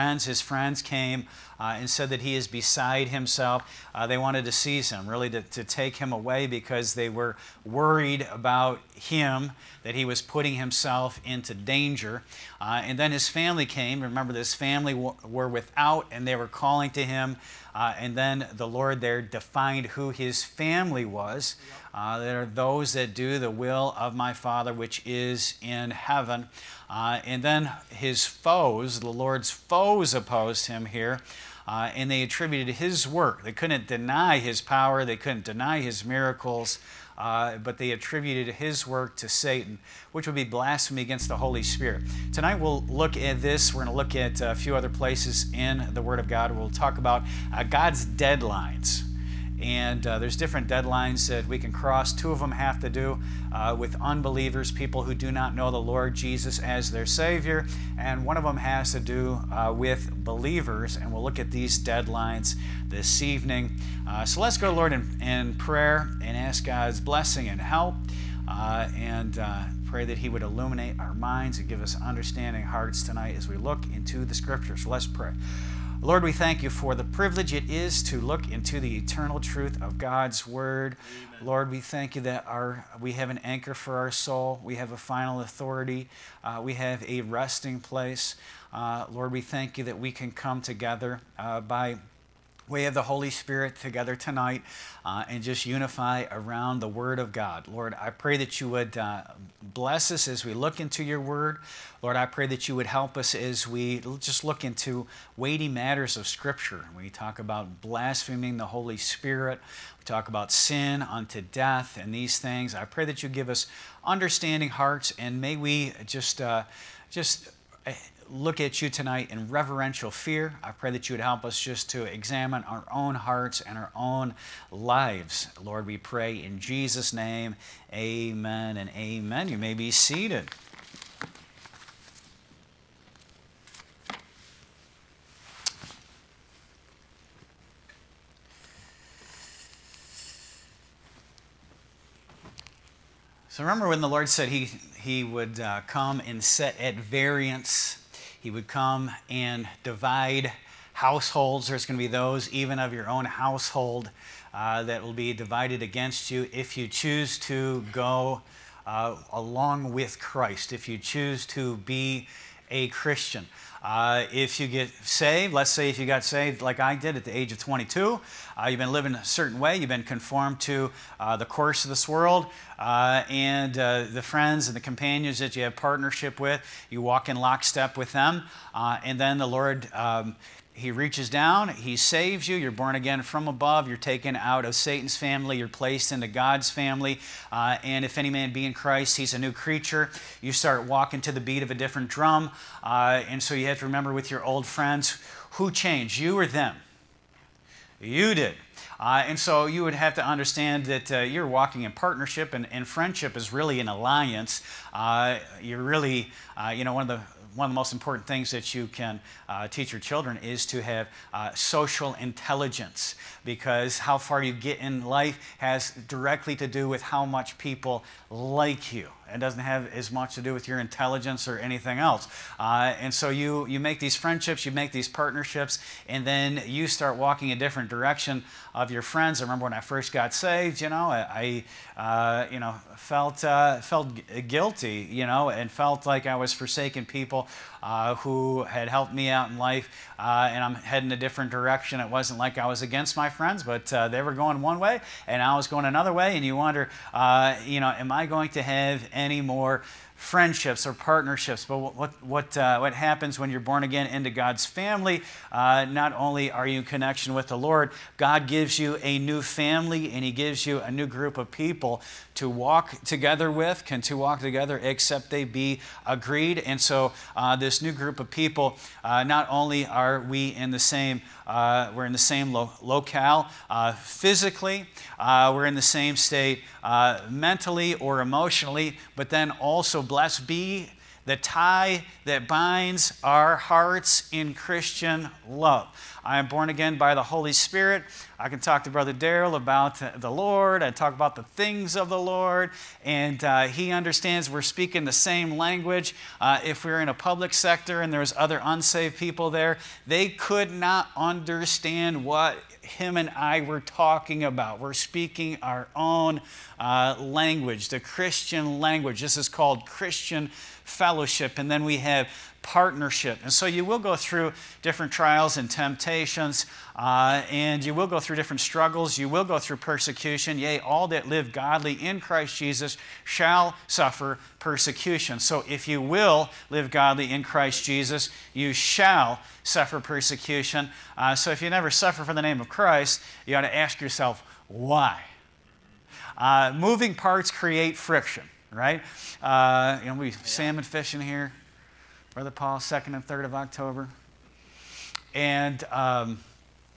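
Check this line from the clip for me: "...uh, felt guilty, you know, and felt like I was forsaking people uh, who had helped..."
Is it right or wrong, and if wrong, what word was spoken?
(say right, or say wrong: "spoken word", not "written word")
right.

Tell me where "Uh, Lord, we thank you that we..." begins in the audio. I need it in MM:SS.
01:28.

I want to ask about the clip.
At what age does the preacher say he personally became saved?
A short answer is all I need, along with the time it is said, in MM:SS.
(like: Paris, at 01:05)
22, at 02:47.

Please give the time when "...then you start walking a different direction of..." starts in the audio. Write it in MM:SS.
03:46.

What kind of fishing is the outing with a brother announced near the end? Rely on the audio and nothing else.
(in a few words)
Salmon.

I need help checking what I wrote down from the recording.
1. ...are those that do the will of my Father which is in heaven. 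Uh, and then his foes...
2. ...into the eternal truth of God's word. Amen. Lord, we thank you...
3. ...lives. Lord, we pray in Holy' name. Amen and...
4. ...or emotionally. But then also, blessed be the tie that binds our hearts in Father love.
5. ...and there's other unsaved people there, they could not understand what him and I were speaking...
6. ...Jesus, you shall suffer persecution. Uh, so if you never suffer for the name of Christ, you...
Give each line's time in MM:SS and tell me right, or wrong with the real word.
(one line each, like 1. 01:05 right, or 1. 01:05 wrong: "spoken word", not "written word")
1. 00:22 right
2. 01:18 right
3. 02:04 wrong: "Jesus", not "Holy"
4. 04:37 wrong: "Christian", not "Father"
5. 04:58 wrong: "talking", not "speaking"
6. 05:27 right.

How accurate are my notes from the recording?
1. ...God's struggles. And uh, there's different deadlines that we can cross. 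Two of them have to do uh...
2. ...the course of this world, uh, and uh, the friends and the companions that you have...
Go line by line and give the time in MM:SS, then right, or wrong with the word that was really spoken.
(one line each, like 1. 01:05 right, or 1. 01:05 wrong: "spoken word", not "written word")
1. 00:47 wrong: "deadlines", not "struggles"
2. 02:51 right.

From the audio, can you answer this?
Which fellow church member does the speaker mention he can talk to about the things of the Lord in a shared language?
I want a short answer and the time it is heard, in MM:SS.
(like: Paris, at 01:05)
Brother Daryl, at 04:48.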